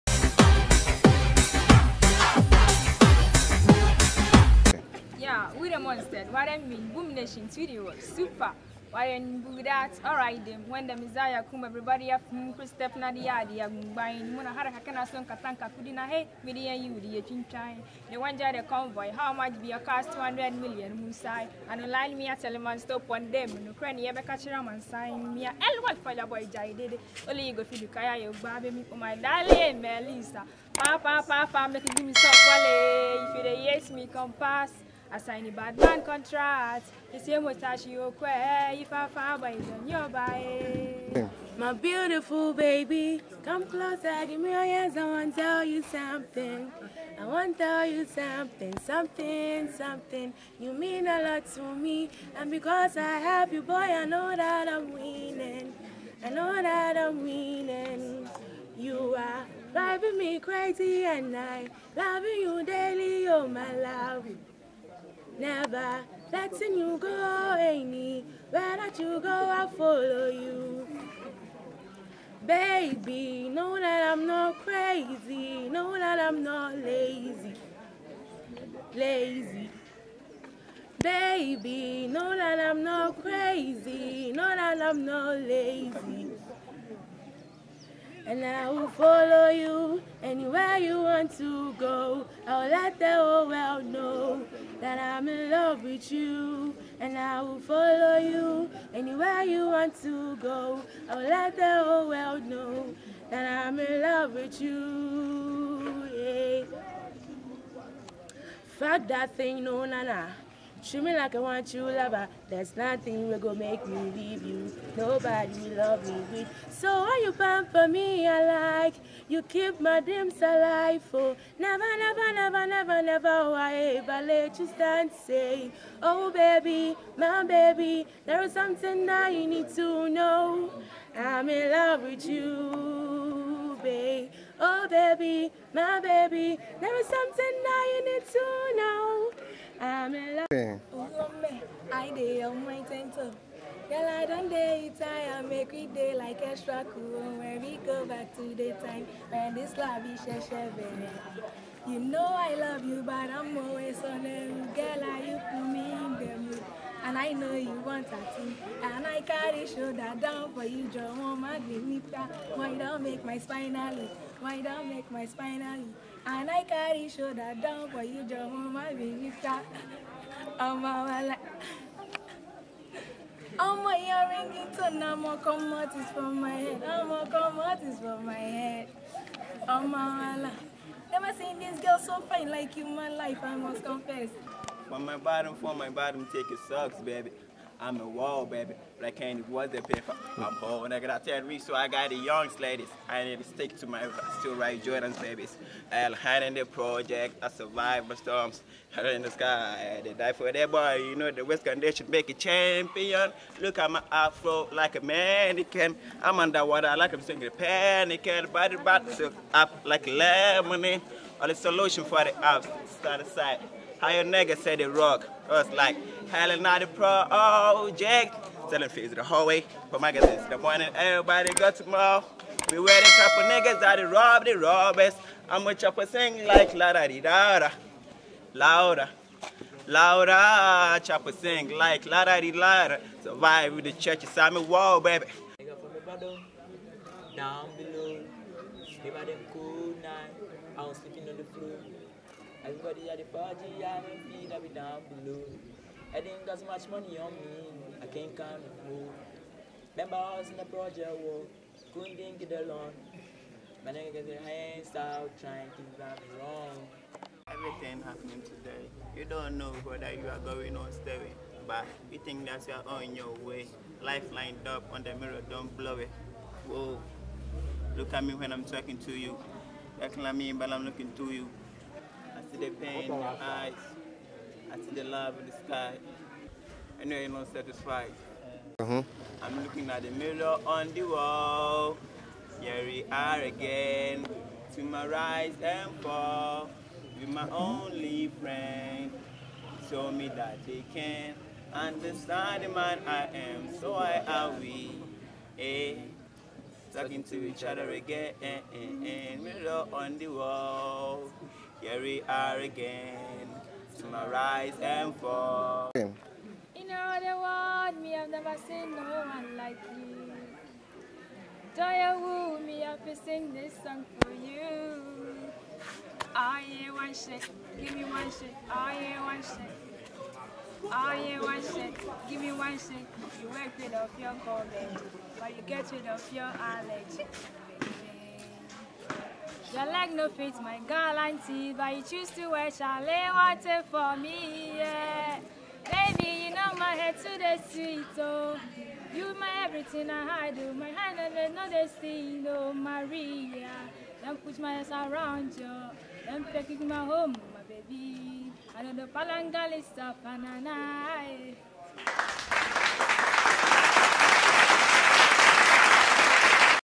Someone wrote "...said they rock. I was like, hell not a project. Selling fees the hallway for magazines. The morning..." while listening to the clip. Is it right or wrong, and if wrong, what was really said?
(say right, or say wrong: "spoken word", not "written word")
right.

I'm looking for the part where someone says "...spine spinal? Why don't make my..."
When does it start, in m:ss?
2:43.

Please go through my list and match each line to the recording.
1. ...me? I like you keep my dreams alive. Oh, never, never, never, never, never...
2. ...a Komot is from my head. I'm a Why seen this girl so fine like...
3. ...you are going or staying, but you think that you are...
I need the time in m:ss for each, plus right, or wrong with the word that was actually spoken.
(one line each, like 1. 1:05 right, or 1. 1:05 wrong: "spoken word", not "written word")
1. 1:57 right
2. 2:57 wrong: "Never", not "Why"
3. 4:20 right.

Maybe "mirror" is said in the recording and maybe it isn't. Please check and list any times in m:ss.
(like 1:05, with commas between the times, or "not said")
4:25, 4:40, 4:59.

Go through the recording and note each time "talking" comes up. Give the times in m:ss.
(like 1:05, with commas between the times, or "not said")
4:28, 4:56.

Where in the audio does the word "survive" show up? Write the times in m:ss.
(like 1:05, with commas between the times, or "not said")
3:17, 3:53.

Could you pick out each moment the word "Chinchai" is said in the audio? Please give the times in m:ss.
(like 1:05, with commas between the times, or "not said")
0:17.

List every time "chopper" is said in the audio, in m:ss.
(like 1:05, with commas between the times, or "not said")
3:45, 3:51.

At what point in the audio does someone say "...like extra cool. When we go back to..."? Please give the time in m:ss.
2:26.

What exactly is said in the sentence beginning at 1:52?
There's nothing will go make me leave you.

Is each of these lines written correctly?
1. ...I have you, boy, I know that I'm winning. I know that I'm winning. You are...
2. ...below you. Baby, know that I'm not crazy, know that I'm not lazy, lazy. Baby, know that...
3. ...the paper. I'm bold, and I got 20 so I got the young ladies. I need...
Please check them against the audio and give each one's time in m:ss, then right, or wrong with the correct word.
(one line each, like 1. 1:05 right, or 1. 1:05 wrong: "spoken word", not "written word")
1. 0:52 right
2. 1:09 wrong: "follow", not "below"
3. 3:09 wrong: "10", not "20".